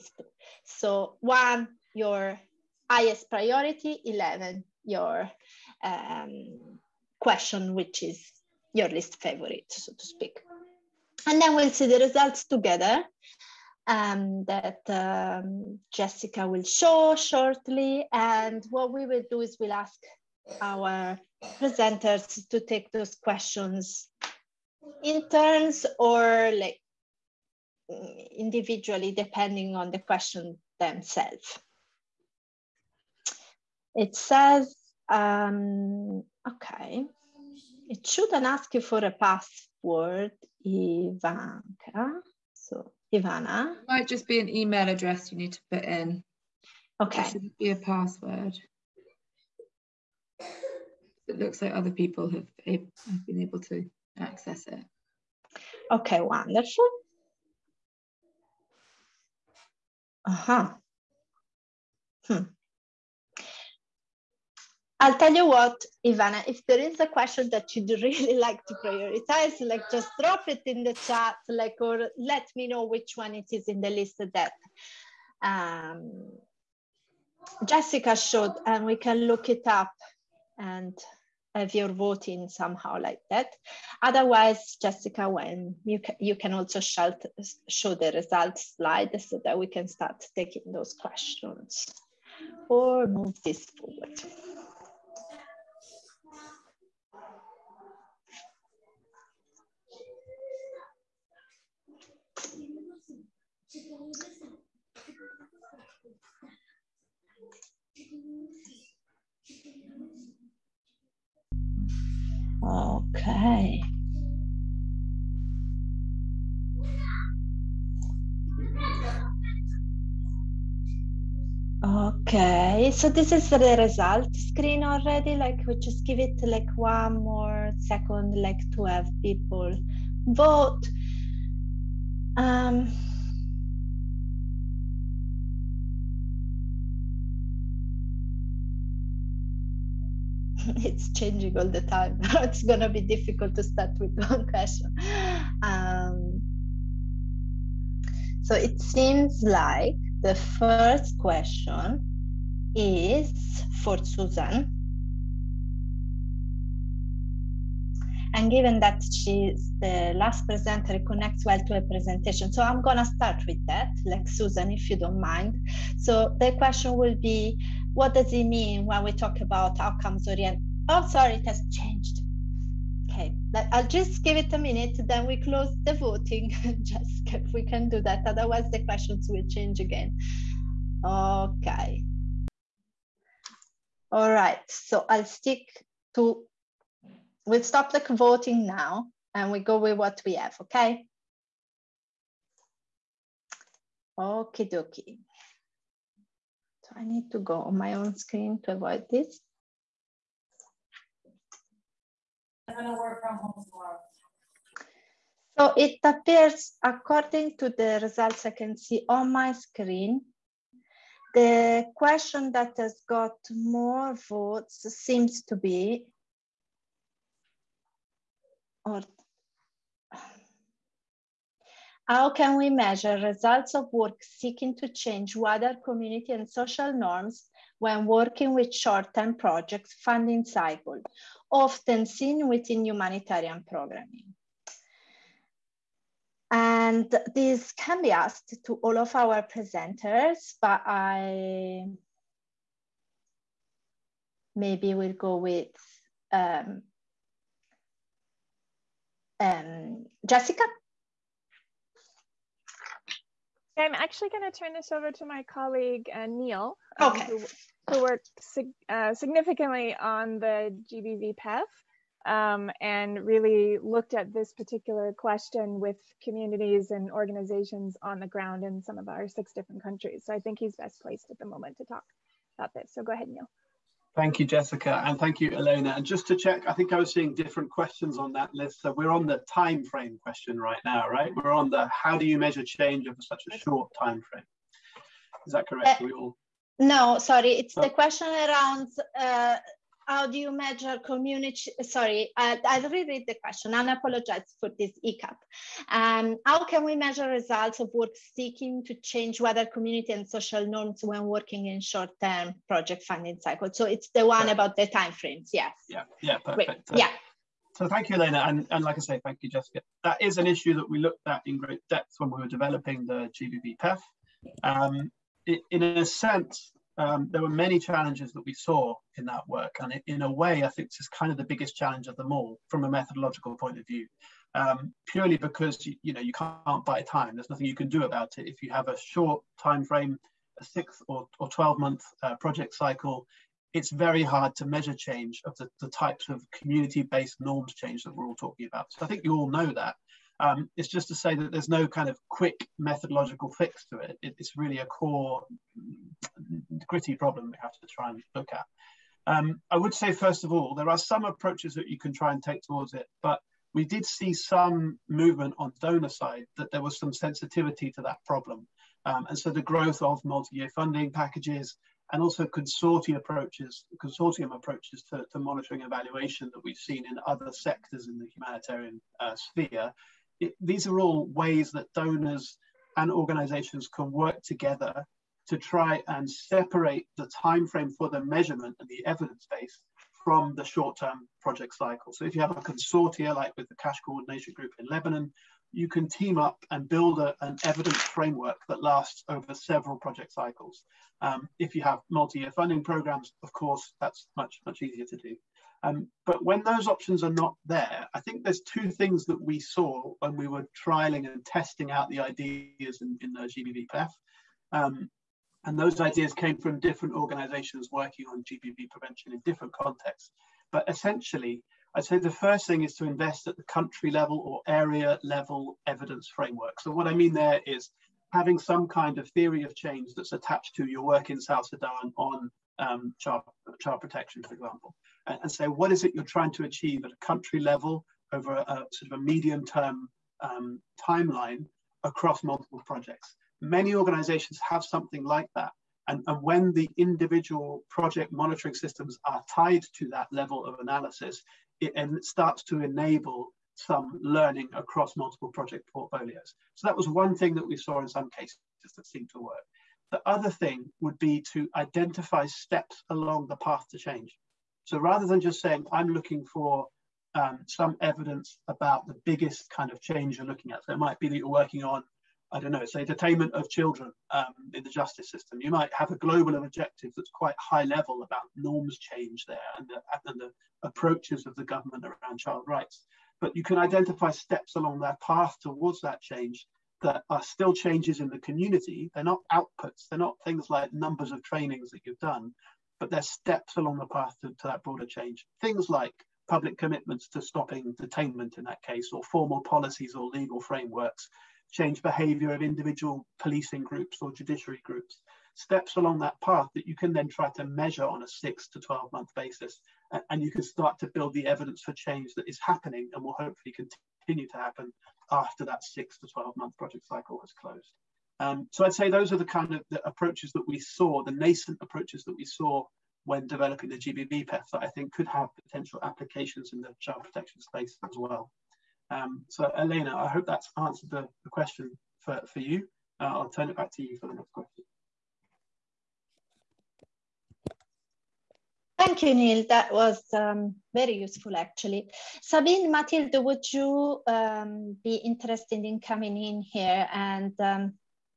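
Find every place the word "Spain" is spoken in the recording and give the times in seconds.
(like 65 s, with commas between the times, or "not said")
not said.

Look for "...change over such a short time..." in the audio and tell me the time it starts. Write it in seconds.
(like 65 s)
282 s.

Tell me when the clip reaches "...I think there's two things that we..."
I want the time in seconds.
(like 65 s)
398 s.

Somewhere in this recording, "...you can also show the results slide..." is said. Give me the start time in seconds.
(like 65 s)
86 s.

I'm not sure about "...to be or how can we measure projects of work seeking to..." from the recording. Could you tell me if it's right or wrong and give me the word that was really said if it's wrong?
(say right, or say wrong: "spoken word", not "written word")
wrong: "results", not "projects".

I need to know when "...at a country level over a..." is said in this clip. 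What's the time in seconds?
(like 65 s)
427 s.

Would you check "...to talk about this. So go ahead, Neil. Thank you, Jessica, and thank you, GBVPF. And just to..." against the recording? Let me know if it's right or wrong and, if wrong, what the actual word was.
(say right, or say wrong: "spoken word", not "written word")
wrong: "Elena", not "GBVPF".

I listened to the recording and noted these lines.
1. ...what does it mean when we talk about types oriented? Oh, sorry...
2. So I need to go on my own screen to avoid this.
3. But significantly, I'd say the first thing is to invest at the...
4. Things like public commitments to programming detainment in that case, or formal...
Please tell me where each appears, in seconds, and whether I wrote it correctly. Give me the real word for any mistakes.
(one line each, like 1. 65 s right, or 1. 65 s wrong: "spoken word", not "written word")
1. 167 s wrong: "outcomes", not "types"
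2. 196 s right
3. 410 s wrong: "essentially", not "significantly"
4. 485 s wrong: "stopping", not "programming".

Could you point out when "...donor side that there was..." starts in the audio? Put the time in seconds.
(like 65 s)
355 s.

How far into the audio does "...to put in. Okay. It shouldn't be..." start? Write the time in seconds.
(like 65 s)
45 s.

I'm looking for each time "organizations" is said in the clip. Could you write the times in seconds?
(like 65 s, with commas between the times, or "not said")
267 s, 373 s, 407 s, 433 s.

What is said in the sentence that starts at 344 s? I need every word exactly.
it it's really a core gritty problem we have to try and look at.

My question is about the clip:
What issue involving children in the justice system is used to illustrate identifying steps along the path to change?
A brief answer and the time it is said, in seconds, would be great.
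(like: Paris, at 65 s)
Detainment of children, at 463 s.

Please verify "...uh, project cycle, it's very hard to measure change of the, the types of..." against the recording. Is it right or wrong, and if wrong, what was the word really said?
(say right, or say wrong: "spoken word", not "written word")
right.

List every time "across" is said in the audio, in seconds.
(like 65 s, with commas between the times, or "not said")
432 s, 444 s.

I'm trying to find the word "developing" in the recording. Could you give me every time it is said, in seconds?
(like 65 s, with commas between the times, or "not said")
312 s, 513 s.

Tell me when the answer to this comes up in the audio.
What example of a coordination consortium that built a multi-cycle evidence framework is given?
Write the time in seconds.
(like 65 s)
383 s.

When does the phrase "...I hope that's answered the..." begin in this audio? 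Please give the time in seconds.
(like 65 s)
520 s.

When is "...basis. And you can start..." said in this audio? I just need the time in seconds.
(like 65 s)
499 s.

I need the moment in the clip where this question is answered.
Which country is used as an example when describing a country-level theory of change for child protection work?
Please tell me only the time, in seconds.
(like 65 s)
421 s.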